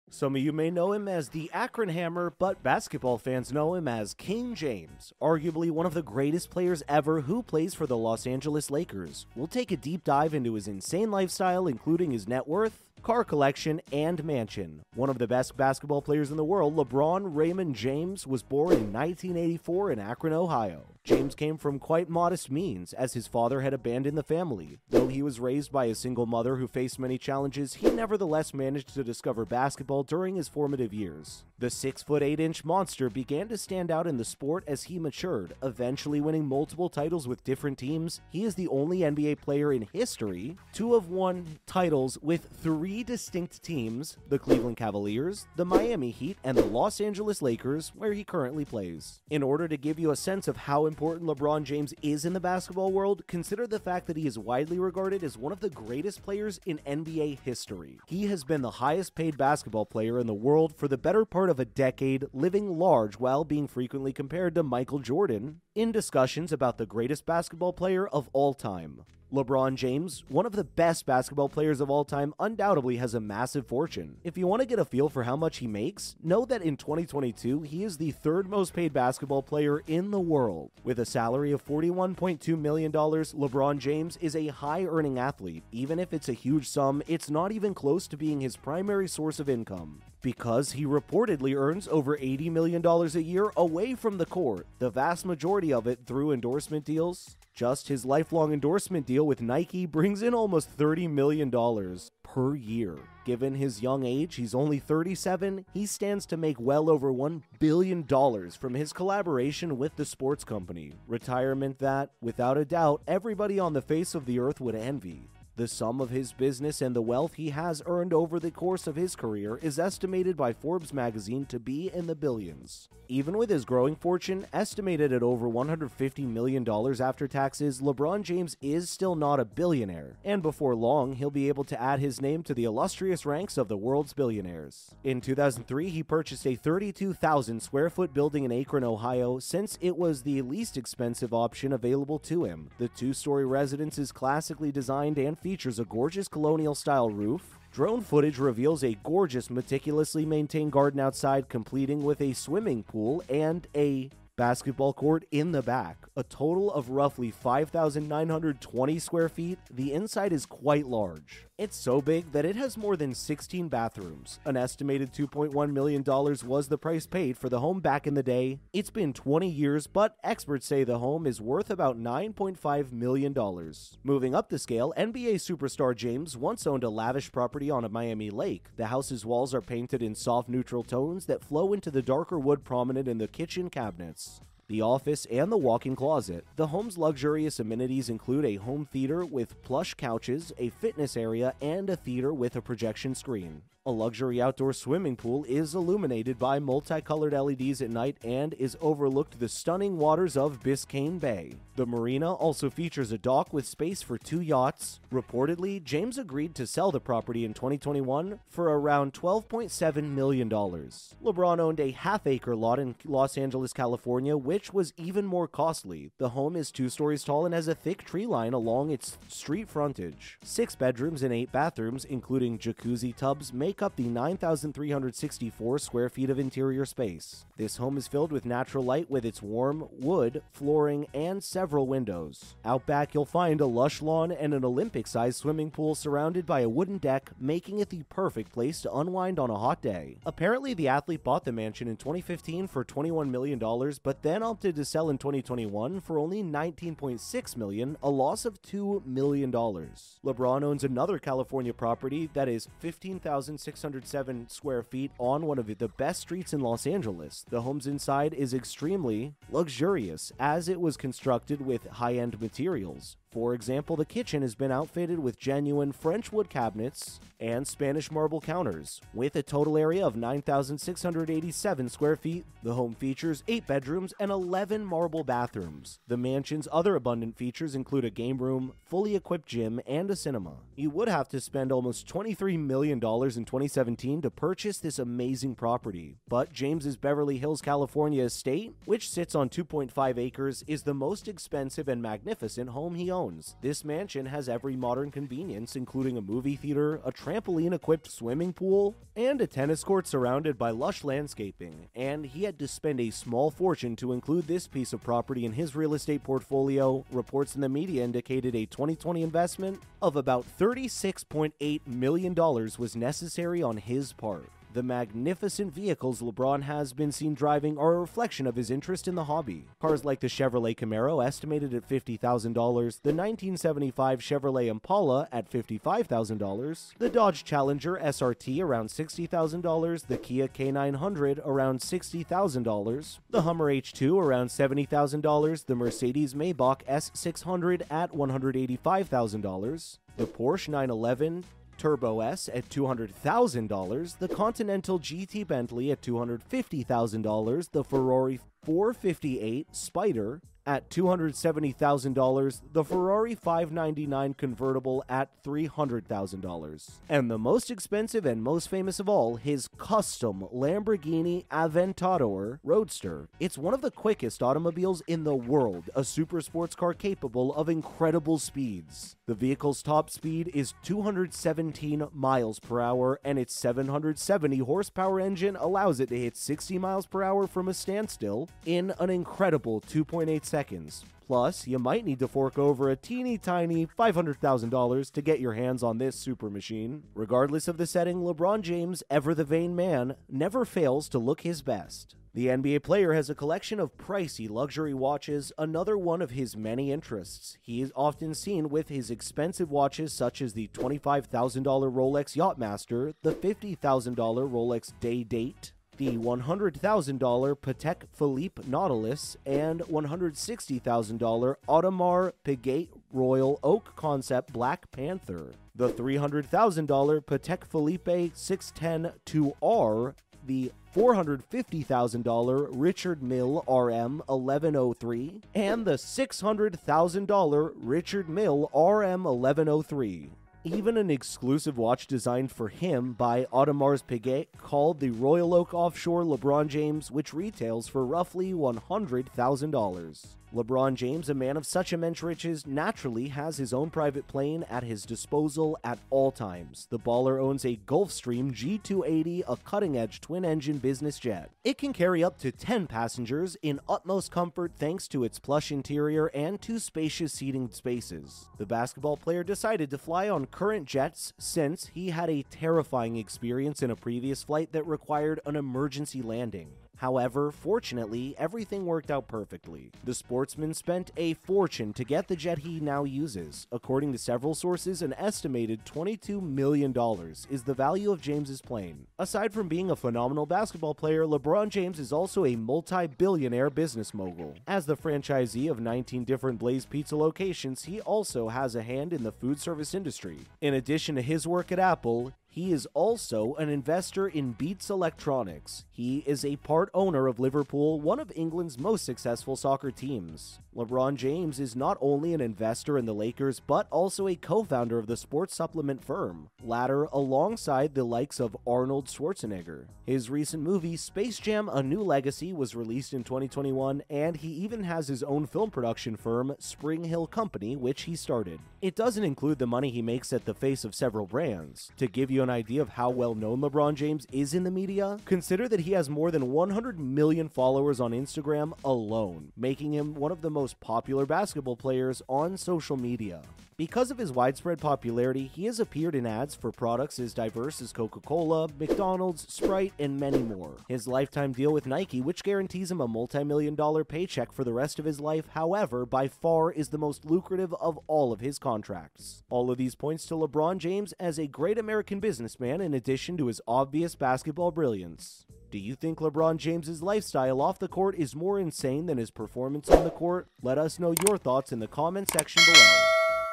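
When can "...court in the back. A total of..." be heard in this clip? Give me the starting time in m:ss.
2:34.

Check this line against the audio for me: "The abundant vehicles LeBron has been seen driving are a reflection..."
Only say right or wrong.
wrong.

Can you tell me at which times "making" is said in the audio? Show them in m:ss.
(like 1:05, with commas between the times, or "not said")
3:57, 8:49.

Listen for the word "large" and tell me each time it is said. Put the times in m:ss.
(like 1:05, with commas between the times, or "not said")
1:02, 2:40.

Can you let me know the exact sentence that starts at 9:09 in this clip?
All of these points to LeBron James as a great American business businessman in addition to his obvious basketball brilliance.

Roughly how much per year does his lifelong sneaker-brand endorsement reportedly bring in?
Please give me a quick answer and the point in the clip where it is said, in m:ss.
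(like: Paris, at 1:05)
$30 million, at 1:40.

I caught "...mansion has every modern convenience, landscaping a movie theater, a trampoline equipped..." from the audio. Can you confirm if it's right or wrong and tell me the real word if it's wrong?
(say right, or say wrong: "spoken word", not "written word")
wrong: "including", not "landscaping".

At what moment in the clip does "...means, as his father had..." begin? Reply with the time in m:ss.
0:22.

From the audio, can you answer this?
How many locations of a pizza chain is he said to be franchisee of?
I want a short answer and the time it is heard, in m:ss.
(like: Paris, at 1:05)
19, at 8:05.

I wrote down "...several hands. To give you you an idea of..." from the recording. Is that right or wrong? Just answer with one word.
wrong.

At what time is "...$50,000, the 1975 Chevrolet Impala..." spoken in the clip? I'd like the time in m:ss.
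5:21.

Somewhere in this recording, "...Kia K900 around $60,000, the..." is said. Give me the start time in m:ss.
5:30.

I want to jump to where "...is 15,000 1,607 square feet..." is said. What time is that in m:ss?
4:12.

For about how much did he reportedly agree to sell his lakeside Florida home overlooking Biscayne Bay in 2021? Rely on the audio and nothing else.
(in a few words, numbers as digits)
$12.7 million.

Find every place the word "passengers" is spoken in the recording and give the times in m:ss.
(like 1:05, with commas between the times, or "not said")
7:32.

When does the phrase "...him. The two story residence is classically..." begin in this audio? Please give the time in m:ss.
2:22.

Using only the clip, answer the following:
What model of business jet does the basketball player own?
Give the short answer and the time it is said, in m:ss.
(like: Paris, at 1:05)
Gulfstream G280, at 7:27.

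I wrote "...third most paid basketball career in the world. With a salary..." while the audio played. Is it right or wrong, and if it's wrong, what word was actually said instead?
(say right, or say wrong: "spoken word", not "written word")
wrong: "player", not "career".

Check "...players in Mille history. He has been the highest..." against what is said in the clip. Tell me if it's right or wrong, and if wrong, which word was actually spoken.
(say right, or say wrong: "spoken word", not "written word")
wrong: "NBA", not "Mille".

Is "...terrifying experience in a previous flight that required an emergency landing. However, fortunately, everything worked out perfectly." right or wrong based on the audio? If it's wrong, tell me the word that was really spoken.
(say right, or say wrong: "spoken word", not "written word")
right.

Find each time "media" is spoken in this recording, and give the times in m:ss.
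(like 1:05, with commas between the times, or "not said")
5:07, 8:44, 8:52.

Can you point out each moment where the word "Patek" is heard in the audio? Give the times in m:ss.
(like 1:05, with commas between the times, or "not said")
6:47, 6:57.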